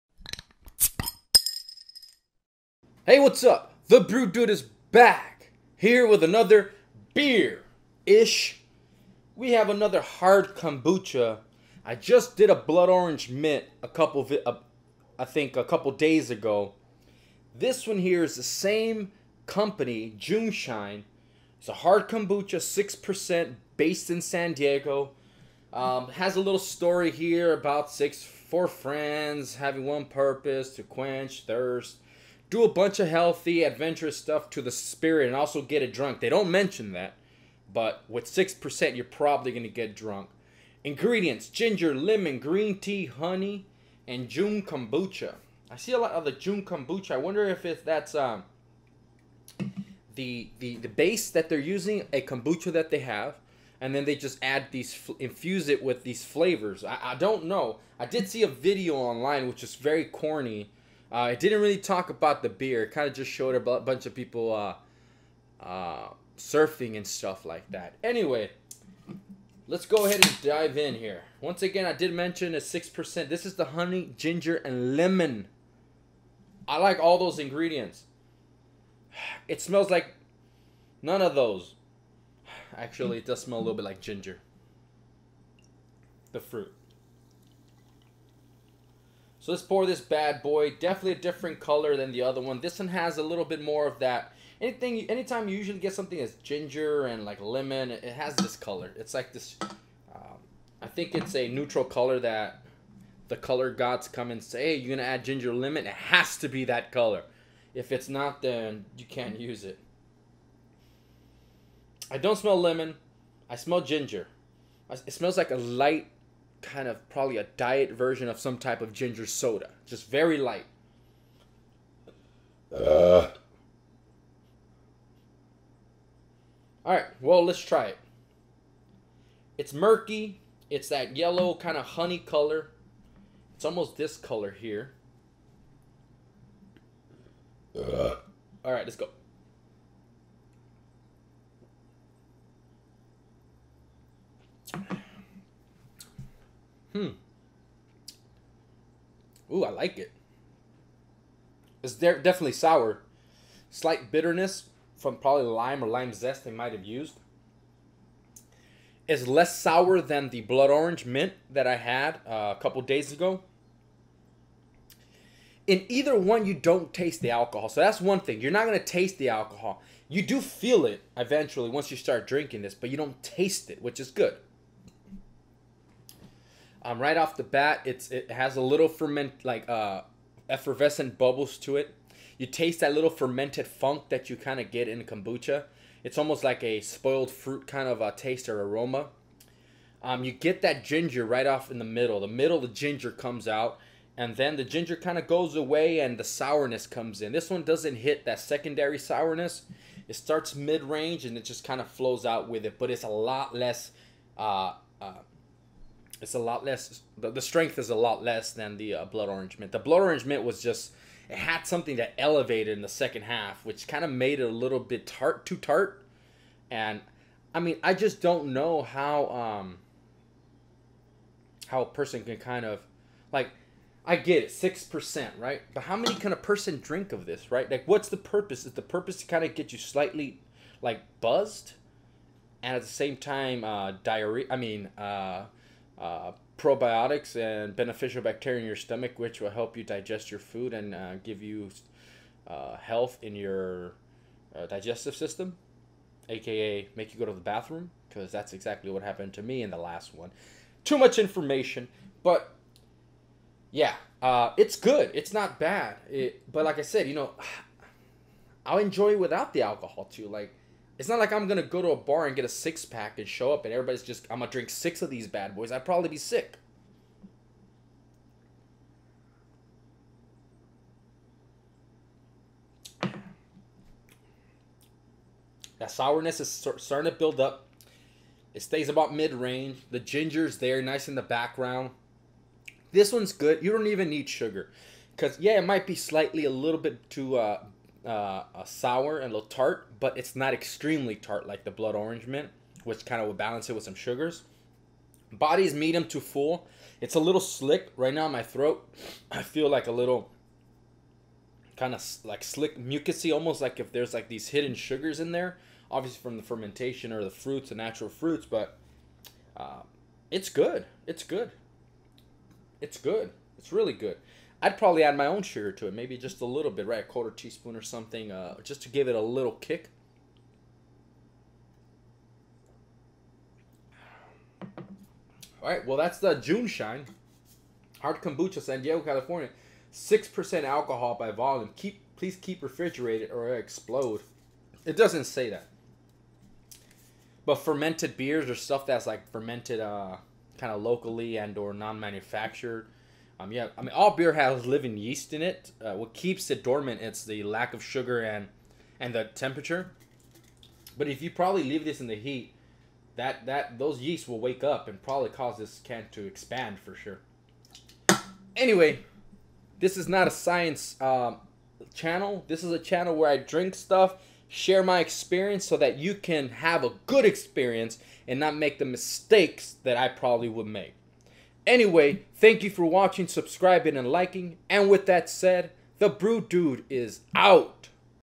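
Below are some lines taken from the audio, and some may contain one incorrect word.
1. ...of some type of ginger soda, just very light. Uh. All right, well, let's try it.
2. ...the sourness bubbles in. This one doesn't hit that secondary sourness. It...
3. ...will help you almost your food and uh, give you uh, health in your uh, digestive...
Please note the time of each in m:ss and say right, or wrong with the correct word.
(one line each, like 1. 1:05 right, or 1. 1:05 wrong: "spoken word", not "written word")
1. 1:58 right
2. 3:16 wrong: "comes", not "bubbles"
3. 3:59 wrong: "digest", not "almost".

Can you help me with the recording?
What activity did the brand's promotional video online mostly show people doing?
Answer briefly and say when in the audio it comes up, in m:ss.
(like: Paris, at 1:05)
surfing, at 1:06.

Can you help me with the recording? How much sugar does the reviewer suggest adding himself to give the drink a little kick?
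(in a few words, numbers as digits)
a quarter teaspoon.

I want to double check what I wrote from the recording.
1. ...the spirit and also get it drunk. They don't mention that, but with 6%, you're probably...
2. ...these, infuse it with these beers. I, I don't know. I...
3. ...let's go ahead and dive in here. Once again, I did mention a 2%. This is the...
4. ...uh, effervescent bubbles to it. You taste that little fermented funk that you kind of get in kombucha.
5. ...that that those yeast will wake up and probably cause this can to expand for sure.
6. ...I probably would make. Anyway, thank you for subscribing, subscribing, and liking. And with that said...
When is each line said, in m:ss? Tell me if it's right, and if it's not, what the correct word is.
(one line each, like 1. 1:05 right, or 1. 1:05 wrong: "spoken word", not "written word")
1. 0:34 right
2. 0:54 wrong: "flavors", not "beers"
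3. 1:09 wrong: "6", not "2"
4. 2:59 right
5. 5:53 right
6. 6:09 wrong: "watching", not "subscribing".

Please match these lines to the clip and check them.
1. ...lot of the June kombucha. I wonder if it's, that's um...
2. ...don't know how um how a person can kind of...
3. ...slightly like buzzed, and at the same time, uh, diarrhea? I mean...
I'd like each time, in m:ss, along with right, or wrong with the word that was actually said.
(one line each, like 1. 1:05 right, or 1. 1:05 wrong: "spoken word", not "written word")
1. 0:45 right
2. 3:38 right
3. 3:49 right.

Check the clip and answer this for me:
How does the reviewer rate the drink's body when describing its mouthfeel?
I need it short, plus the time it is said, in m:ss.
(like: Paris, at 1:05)
medium to full, at 4:55.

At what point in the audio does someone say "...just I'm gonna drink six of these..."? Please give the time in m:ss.
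4:24.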